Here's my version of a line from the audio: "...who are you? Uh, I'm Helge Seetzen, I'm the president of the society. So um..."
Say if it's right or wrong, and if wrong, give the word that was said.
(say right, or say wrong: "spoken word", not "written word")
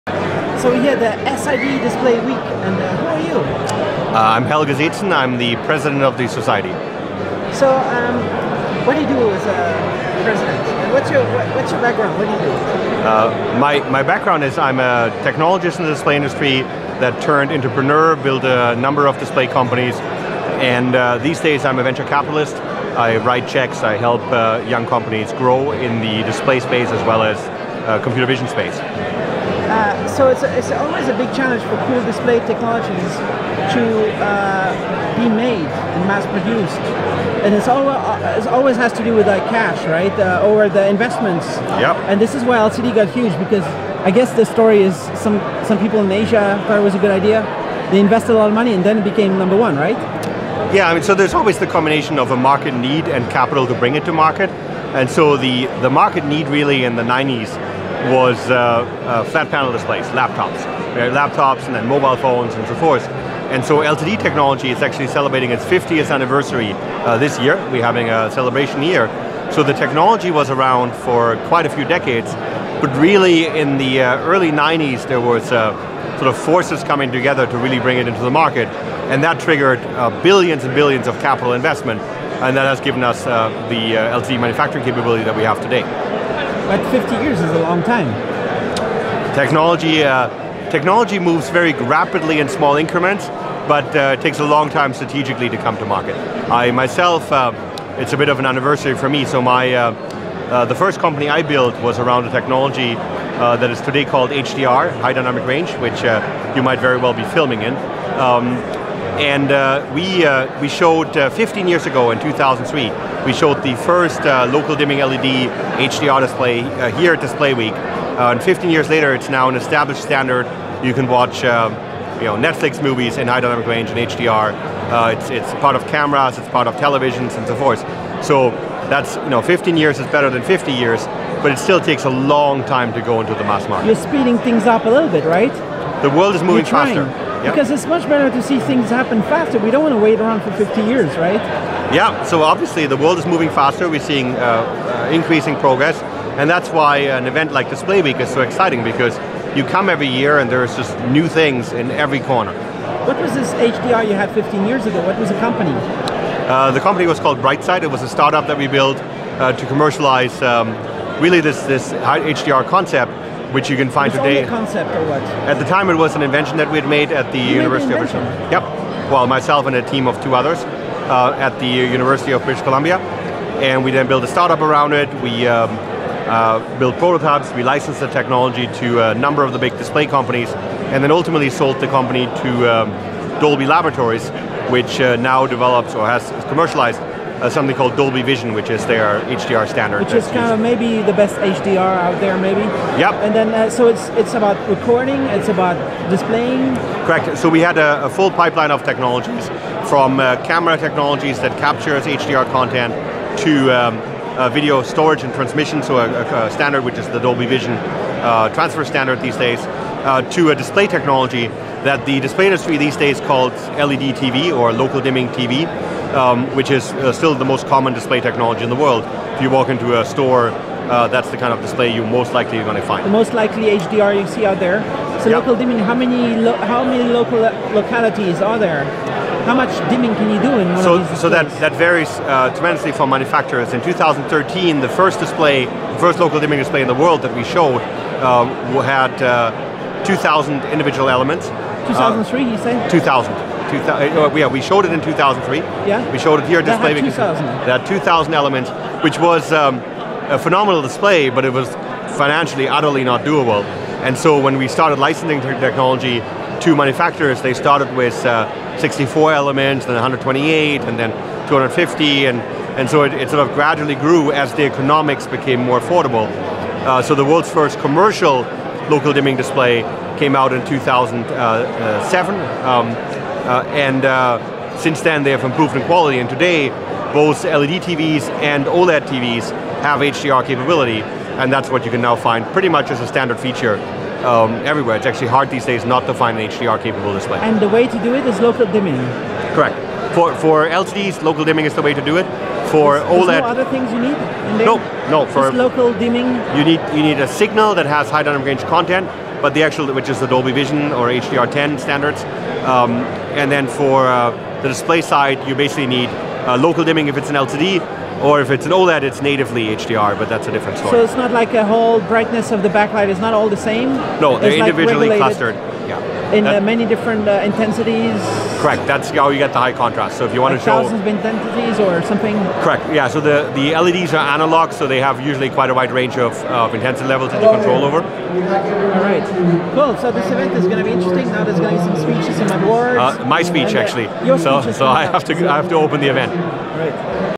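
right.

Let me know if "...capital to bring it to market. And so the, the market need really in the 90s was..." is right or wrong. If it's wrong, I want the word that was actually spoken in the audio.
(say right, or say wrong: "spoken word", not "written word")
right.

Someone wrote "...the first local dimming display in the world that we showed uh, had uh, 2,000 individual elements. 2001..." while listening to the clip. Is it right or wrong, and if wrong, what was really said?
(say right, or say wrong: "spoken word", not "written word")
wrong: "2003", not "2001".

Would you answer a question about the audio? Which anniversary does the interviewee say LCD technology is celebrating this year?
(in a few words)
50th.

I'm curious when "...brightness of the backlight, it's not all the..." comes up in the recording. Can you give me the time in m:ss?
5:12.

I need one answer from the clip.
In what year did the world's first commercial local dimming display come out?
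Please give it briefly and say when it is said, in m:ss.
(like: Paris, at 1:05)
2007, at 4:30.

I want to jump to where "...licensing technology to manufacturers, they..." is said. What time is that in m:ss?
4:14.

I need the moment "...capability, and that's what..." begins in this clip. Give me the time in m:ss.
4:40.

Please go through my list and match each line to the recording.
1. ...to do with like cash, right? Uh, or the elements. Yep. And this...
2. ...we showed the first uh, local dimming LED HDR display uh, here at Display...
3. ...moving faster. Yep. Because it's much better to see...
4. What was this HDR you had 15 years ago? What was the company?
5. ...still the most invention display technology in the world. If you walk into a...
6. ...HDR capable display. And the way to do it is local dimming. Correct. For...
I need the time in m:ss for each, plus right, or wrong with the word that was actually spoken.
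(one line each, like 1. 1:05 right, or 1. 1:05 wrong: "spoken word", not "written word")
1. 0:38 wrong: "investments", not "elements"
2. 1:53 right
3. 2:16 right
4. 2:33 right
5. 3:37 wrong: "common", not "invention"
6. 4:46 right.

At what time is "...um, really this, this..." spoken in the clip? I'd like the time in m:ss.
2:40.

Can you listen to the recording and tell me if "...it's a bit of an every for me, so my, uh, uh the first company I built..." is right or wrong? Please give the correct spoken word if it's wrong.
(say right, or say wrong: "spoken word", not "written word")
wrong: "anniversary", not "every".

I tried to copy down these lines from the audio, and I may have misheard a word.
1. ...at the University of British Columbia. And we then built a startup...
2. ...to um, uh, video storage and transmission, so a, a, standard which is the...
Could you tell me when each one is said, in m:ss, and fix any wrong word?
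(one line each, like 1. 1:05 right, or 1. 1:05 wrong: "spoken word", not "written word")
1. 2:51 right
2. 3:23 right.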